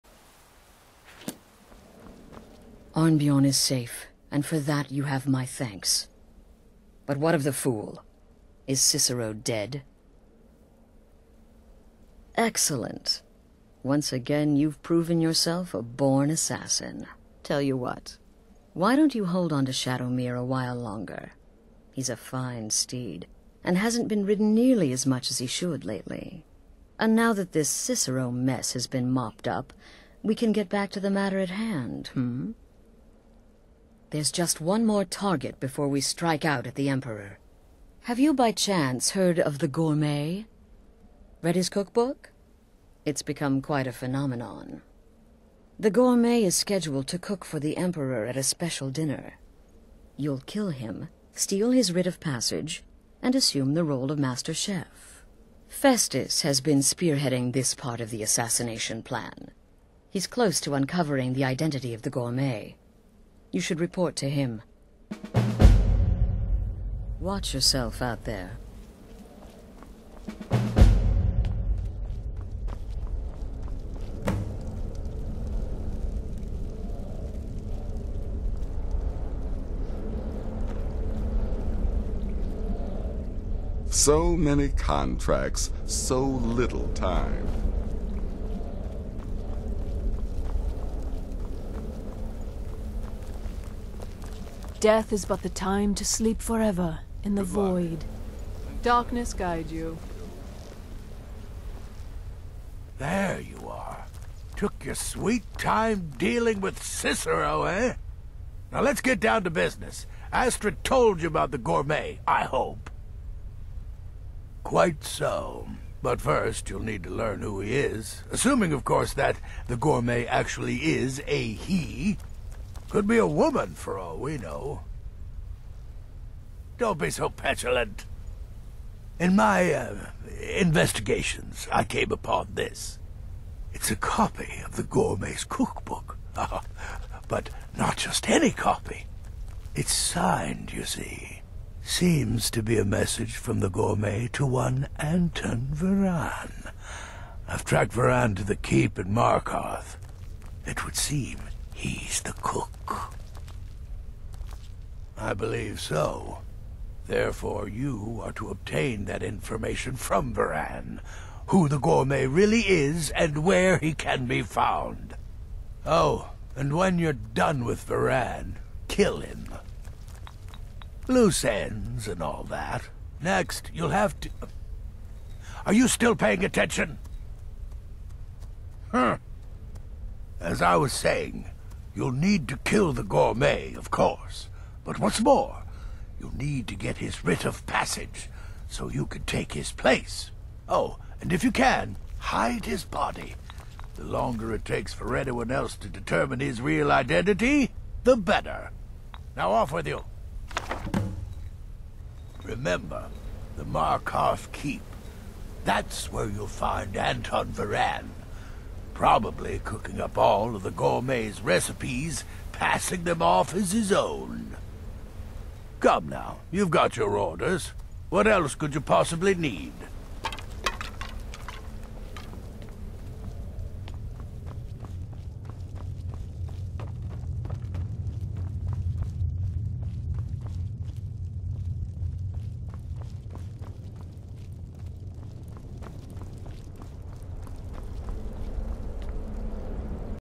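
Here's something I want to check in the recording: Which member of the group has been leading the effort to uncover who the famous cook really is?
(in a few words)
Festus.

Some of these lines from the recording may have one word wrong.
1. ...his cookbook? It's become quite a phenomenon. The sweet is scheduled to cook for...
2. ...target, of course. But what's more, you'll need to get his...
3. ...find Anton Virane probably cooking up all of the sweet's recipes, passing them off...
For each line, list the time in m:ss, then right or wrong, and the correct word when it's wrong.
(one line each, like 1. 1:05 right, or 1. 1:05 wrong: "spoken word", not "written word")
1. 0:41 wrong: "gourmet", not "sweet"
2. 3:03 wrong: "gourmet", not "target"
3. 3:26 wrong: "gourmet", not "sweet".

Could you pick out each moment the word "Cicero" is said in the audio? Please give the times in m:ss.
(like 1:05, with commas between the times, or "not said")
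0:08, 0:27, 1:46.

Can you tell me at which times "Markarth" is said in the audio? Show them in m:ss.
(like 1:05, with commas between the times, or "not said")
2:29, 3:23.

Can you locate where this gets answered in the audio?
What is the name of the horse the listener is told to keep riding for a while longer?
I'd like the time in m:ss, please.
0:19.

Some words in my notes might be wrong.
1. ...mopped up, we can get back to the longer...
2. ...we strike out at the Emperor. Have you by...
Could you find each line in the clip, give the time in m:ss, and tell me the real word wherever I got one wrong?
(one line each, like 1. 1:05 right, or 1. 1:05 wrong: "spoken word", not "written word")
1. 0:29 wrong: "matter", not "longer"
2. 0:35 right.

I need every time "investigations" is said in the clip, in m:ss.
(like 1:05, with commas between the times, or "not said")
2:10.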